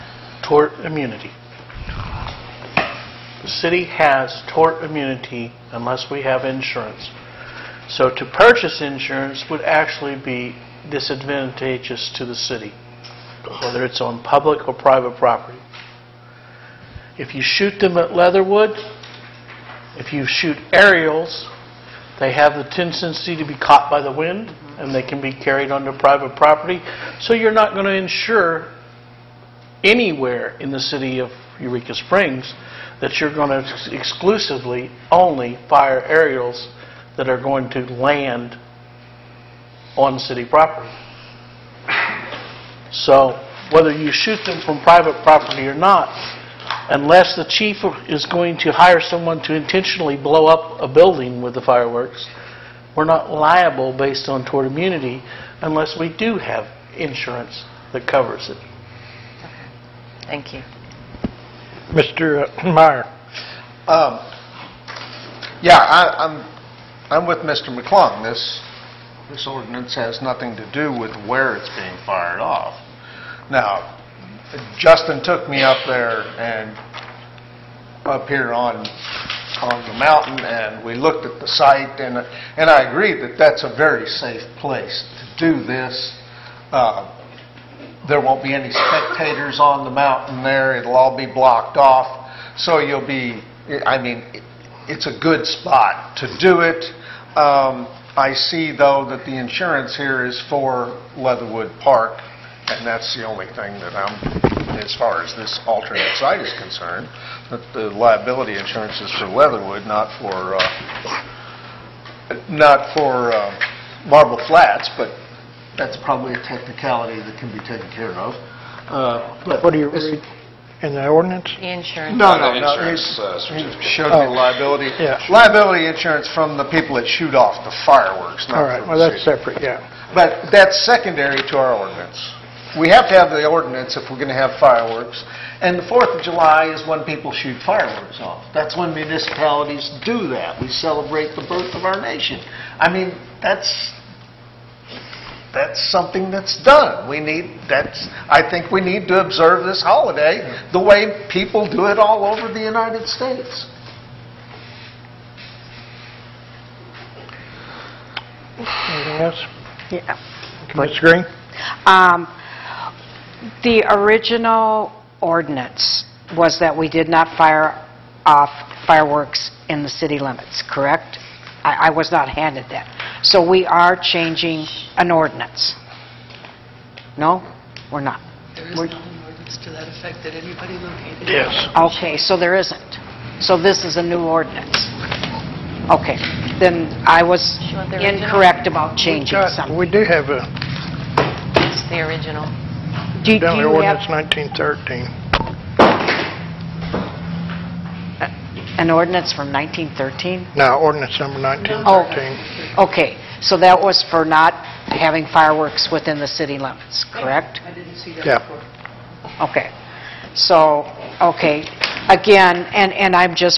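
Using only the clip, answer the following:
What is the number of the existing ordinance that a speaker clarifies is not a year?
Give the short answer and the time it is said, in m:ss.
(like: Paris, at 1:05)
1913, at 3:20.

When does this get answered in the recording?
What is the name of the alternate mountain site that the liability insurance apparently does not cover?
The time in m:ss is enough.
1:54.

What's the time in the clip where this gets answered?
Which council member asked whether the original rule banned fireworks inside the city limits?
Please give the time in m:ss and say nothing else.
2:40.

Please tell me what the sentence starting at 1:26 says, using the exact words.
Uh, there won't be any spectators on the mountain there.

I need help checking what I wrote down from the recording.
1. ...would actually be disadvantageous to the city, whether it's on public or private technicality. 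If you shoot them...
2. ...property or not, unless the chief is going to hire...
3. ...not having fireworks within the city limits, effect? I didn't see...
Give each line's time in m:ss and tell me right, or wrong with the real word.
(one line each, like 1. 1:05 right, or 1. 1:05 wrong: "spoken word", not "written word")
1. 0:09 wrong: "property", not "technicality"
2. 0:45 right
3. 3:24 wrong: "correct", not "effect".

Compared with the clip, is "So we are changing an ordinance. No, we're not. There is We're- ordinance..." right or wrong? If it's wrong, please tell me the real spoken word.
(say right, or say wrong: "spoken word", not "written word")
right.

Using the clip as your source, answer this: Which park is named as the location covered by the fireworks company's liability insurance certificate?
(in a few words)
Leatherwood Park.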